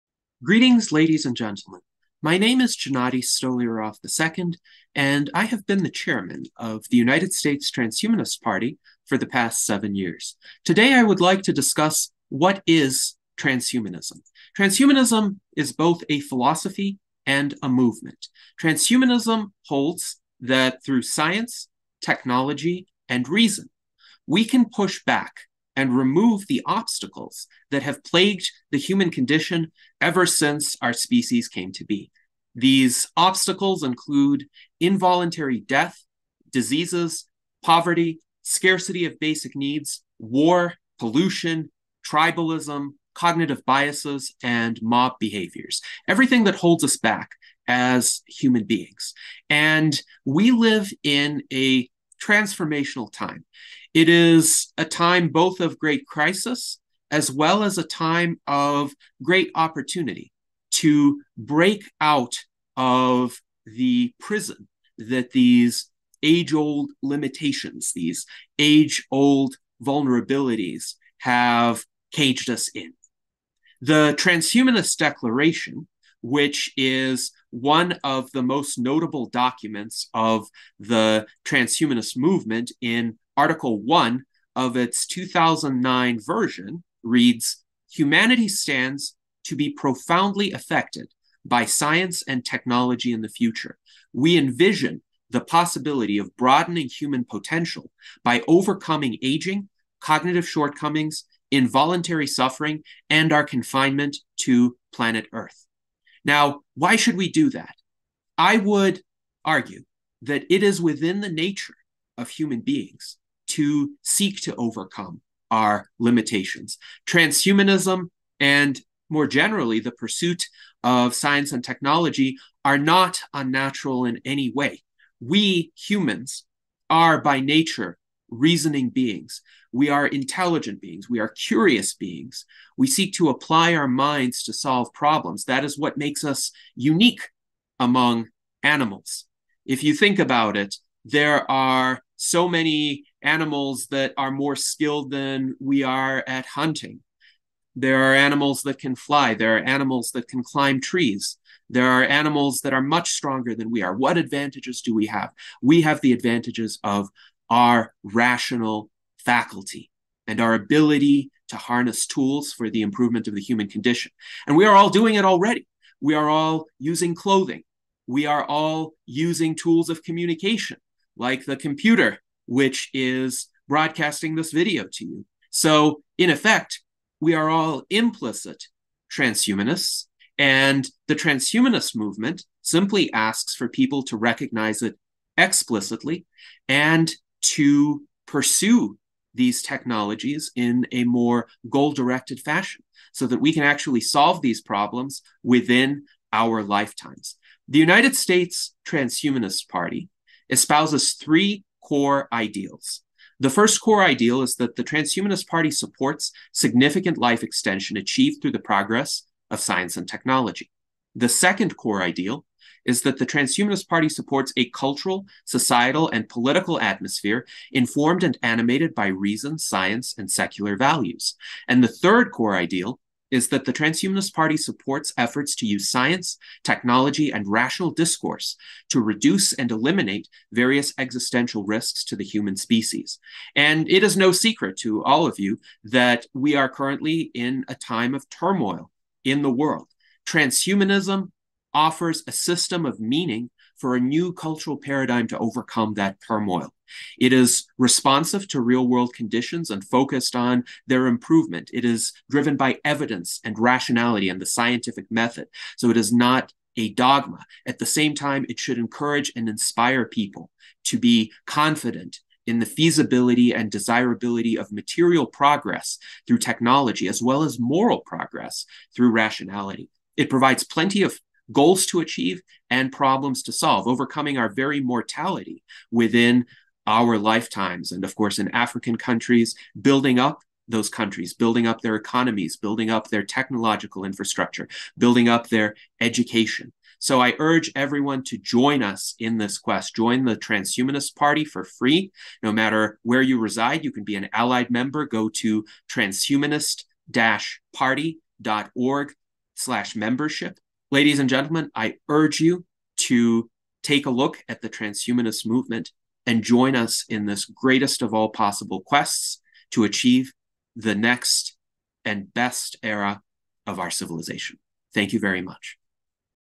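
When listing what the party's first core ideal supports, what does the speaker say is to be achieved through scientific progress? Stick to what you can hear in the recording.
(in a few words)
Significant life extension.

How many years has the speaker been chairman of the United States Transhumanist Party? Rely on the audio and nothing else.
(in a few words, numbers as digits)
7.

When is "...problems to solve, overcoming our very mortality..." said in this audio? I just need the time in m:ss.
4:32.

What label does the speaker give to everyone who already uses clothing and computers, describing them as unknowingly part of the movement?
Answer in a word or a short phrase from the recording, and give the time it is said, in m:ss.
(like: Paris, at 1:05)
Implicit transhumanists, at 2:57.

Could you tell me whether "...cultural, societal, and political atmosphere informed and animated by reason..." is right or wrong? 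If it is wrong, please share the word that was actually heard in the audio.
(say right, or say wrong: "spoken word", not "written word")
right.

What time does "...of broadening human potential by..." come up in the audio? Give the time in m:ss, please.
1:36.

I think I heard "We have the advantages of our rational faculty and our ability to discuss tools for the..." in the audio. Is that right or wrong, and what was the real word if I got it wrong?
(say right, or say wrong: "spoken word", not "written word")
wrong: "harness", not "discuss".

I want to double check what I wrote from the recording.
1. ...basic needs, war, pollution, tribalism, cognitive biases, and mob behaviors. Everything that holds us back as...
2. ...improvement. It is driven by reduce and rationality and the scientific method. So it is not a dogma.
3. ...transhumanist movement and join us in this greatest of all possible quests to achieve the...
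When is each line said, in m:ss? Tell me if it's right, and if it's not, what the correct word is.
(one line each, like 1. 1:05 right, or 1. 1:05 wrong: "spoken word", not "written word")
1. 0:39 right
2. 4:11 wrong: "evidence", not "reduce"
3. 5:04 right.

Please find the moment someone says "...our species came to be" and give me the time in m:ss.
0:30.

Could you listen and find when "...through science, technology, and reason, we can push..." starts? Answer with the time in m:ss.
0:20.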